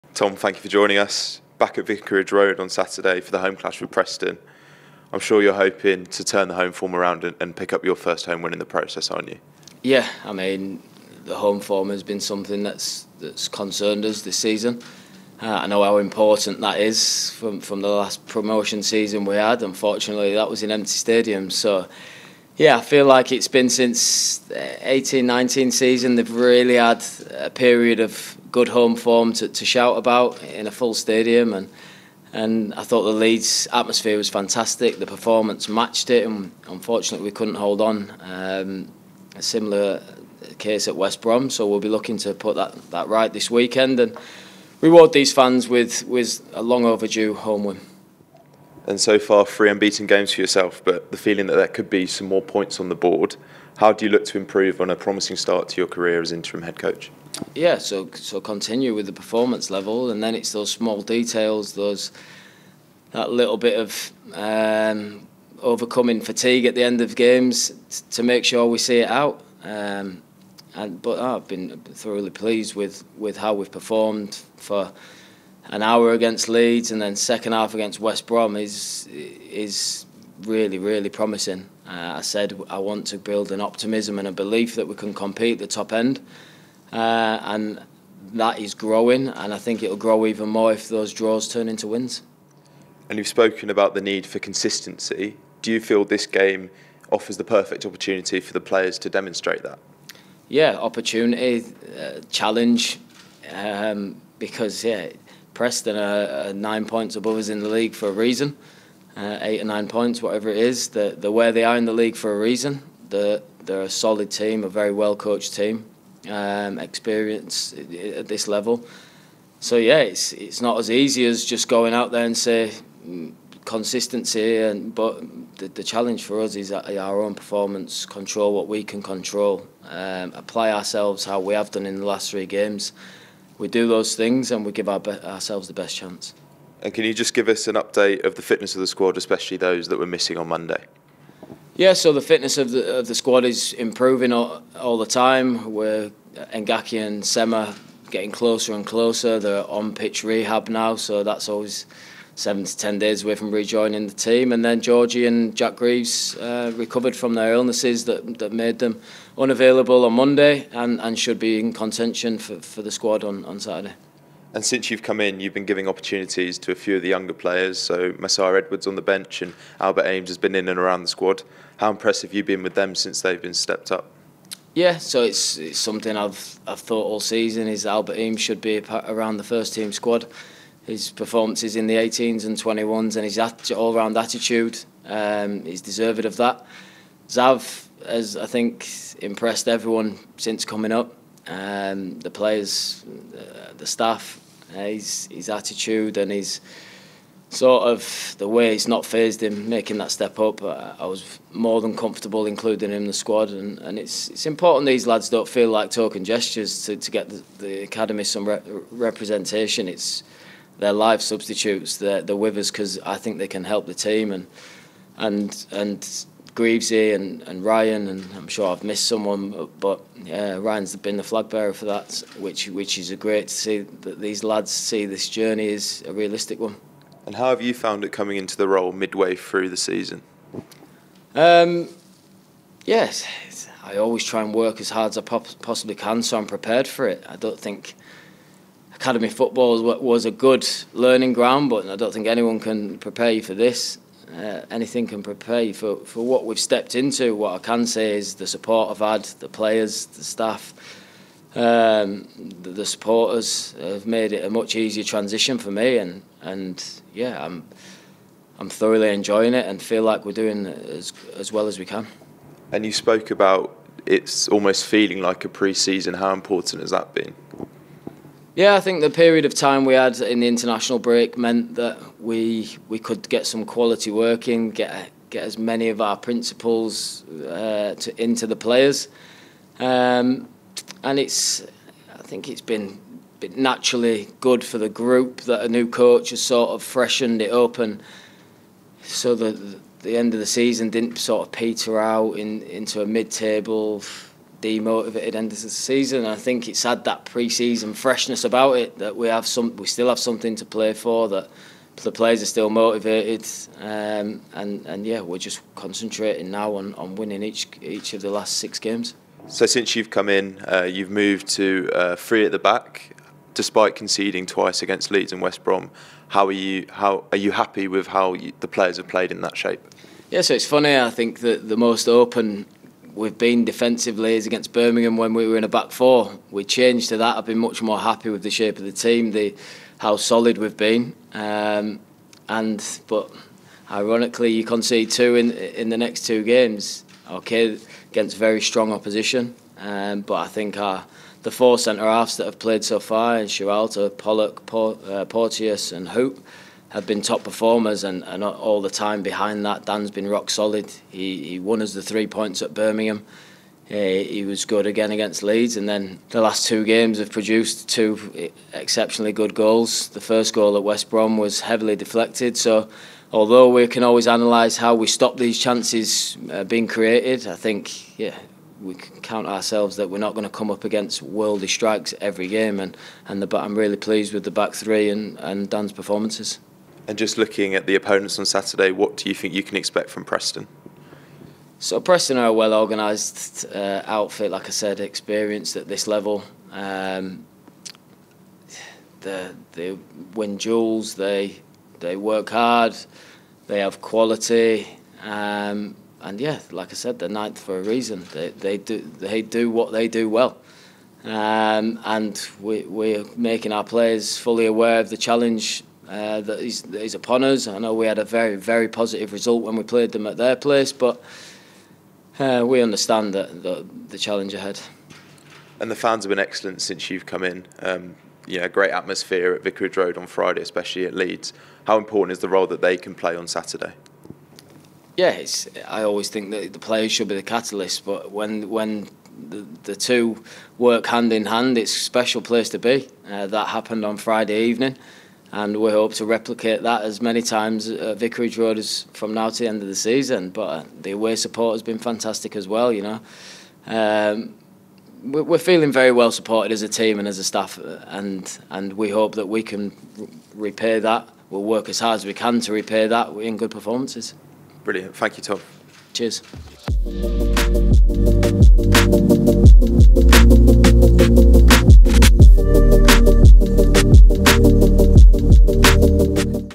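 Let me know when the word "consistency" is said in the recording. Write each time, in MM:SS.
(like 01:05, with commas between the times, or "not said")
01:34, 02:03.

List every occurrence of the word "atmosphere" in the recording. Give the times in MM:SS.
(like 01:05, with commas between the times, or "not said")
00:33, 06:58.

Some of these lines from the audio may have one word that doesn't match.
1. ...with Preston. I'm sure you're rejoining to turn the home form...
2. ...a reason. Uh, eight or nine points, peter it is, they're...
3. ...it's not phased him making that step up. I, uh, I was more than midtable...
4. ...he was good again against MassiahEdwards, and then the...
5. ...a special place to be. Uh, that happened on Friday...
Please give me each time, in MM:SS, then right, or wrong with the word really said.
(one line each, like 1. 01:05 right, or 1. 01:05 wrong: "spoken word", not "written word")
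1. 00:03 wrong: "hoping", not "rejoining"
2. 01:48 wrong: "whatever", not "peter"
3. 03:18 wrong: "comfortable", not "midtable"
4. 05:54 wrong: "Leeds", not "MassiahEdwards"
5. 07:11 right.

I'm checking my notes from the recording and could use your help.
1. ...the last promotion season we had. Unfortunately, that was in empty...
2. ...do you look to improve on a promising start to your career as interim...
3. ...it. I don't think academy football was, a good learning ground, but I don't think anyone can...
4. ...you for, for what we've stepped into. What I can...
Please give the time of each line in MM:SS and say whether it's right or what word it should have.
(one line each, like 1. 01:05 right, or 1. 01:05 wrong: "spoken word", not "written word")
1. 00:17 right
2. 00:53 right
3. 03:57 right
4. 04:05 right.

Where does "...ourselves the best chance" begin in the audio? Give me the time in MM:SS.
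02:15.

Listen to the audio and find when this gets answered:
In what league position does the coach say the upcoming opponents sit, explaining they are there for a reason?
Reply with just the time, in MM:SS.
06:37.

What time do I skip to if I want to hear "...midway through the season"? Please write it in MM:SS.
03:48.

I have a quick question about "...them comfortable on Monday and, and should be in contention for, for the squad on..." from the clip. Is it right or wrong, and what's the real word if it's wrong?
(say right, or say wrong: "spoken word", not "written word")
wrong: "unavailable", not "comfortable".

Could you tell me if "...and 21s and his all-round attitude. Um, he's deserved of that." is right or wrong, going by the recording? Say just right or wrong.
right.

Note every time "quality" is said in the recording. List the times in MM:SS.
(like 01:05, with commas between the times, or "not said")
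04:33, 06:34.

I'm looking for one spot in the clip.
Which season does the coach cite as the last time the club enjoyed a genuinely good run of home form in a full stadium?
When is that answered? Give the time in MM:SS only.
00:24.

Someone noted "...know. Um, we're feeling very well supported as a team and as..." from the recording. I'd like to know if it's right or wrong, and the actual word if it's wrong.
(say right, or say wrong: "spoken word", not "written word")
right.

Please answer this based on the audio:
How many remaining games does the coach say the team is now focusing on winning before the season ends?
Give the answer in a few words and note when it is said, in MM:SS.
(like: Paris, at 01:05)
6, at 05:08.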